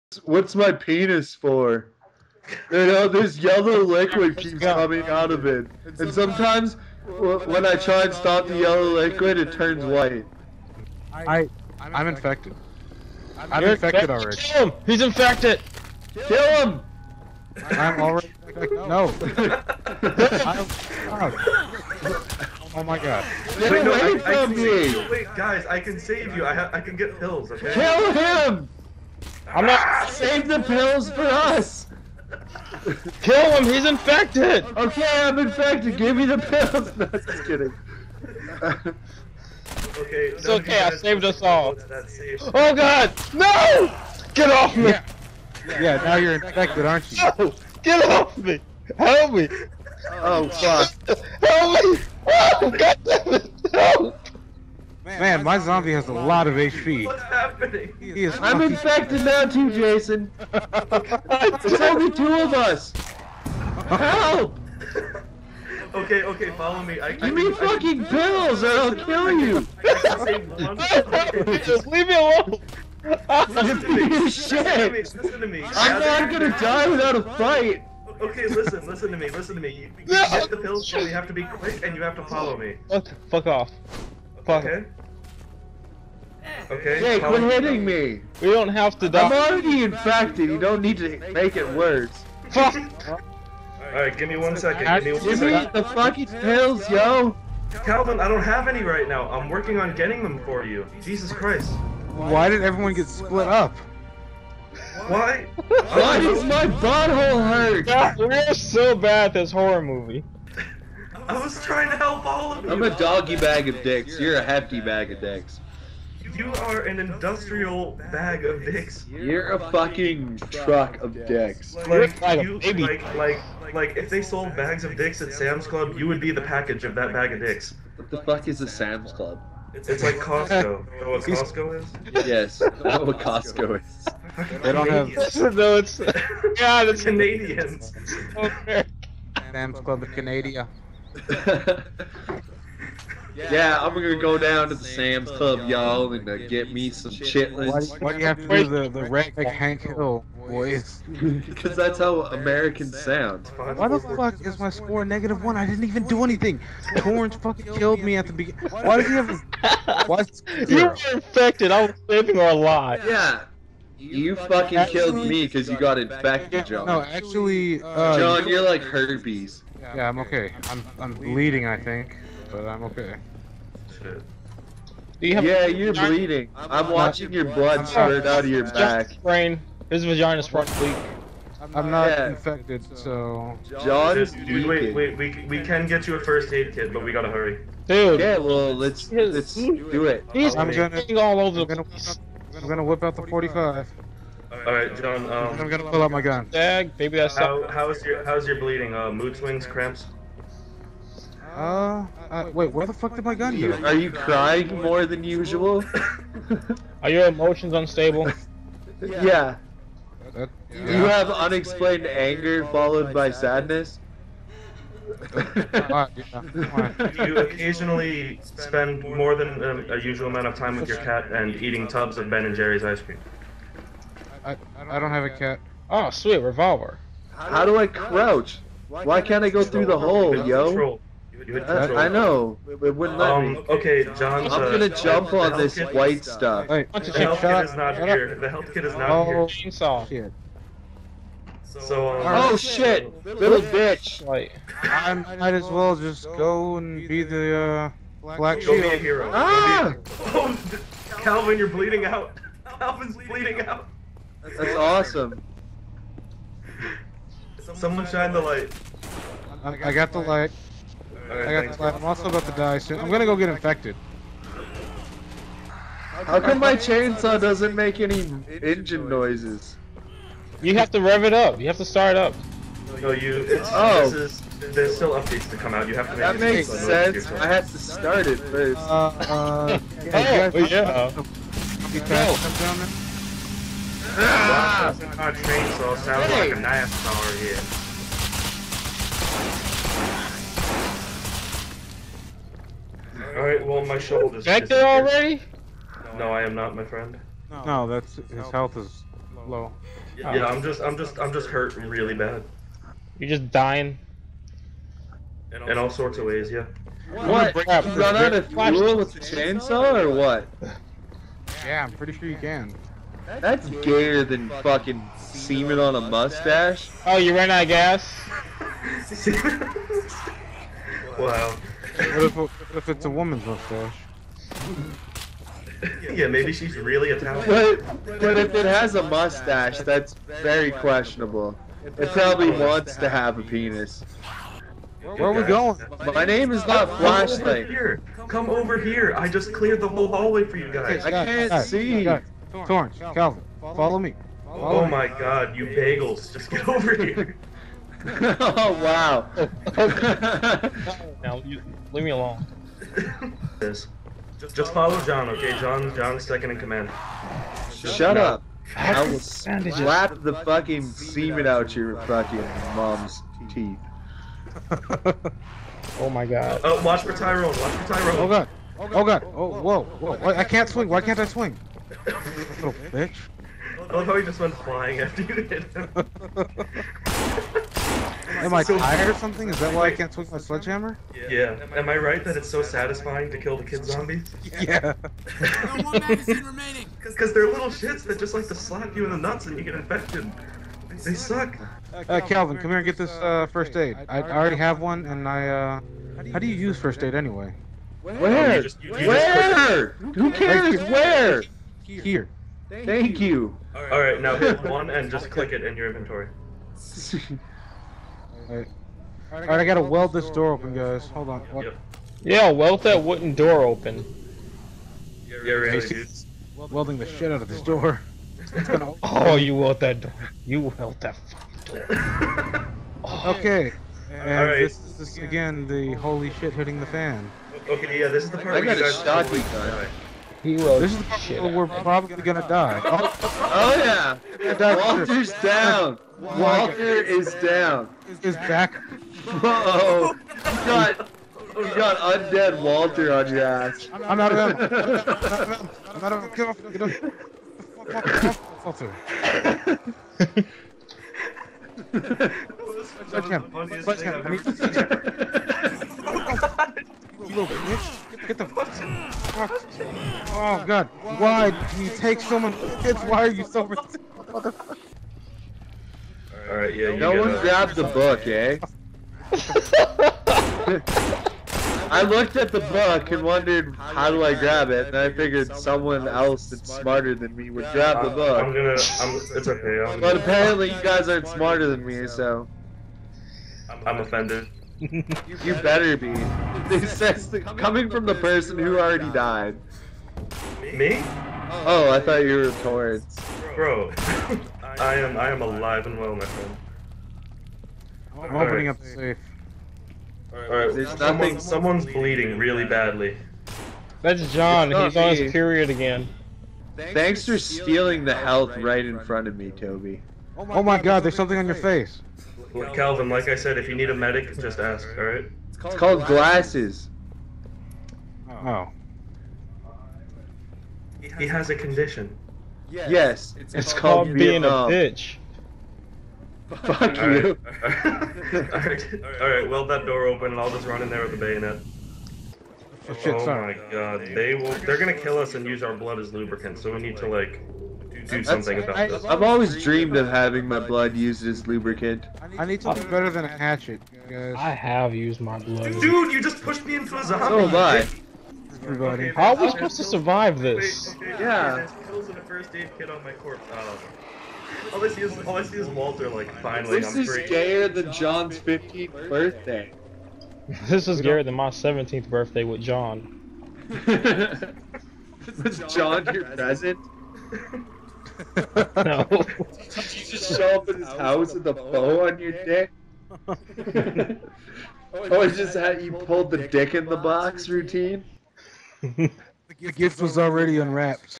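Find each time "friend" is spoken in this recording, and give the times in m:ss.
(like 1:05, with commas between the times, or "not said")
4:56, 8:16.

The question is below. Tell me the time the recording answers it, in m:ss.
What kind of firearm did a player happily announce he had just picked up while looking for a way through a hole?
3:46.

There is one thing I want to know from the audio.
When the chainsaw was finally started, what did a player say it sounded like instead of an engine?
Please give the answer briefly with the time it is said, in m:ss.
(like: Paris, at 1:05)
a knife, at 4:46.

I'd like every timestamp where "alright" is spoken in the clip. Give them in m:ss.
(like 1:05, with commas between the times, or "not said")
1:33, 4:53, 6:48, 7:46, 8:20, 8:34, 8:48.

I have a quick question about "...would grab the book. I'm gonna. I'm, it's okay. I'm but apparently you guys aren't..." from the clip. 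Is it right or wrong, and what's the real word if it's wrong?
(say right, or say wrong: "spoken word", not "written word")
right.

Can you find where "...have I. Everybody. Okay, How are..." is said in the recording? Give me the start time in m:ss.
9:07.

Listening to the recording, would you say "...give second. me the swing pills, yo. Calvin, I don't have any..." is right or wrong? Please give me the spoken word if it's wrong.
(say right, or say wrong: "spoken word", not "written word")
wrong: "fucking", not "swing".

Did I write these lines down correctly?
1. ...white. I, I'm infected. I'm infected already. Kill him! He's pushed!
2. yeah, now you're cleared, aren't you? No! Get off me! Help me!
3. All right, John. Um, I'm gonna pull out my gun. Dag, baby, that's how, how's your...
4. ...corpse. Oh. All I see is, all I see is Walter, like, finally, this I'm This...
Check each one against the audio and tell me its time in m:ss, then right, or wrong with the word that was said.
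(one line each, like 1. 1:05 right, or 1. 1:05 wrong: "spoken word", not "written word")
1. 0:09 wrong: "infected", not "pushed"
2. 0:45 wrong: "infected", not "cleared"
3. 3:14 right
4. 9:13 right.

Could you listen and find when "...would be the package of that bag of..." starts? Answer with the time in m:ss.
2:06.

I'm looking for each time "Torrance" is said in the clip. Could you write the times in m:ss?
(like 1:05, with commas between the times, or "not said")
2:36, 5:42, 8:12.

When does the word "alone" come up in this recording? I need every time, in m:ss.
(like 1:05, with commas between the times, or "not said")
1:12, 5:52.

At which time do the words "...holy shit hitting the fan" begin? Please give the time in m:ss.
7:05.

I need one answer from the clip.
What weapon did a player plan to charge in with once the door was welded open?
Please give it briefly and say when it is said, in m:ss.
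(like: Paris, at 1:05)
bayonet, at 8:51.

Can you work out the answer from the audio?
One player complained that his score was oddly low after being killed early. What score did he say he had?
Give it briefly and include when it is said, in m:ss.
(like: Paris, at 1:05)
-1, at 2:35.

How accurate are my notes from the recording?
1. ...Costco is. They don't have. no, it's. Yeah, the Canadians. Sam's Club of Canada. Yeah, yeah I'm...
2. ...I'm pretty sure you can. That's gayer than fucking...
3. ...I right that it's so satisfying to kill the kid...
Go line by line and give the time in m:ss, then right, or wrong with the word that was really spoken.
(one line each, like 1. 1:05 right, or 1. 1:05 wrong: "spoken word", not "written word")
1. 2:13 right
2. 5:11 right
3. 6:21 right.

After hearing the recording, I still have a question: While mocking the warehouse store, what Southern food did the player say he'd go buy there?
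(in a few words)
chitlins.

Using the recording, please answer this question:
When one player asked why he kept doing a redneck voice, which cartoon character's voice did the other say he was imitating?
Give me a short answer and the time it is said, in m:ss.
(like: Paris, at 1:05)
Hank Hill, at 2:29.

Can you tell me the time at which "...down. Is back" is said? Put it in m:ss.
7:17.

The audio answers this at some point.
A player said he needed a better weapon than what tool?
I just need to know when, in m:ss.
9:03.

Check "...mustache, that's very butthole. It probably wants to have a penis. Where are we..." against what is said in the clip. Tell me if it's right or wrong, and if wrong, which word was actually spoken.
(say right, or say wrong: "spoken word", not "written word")
wrong: "questionable", not "butthole".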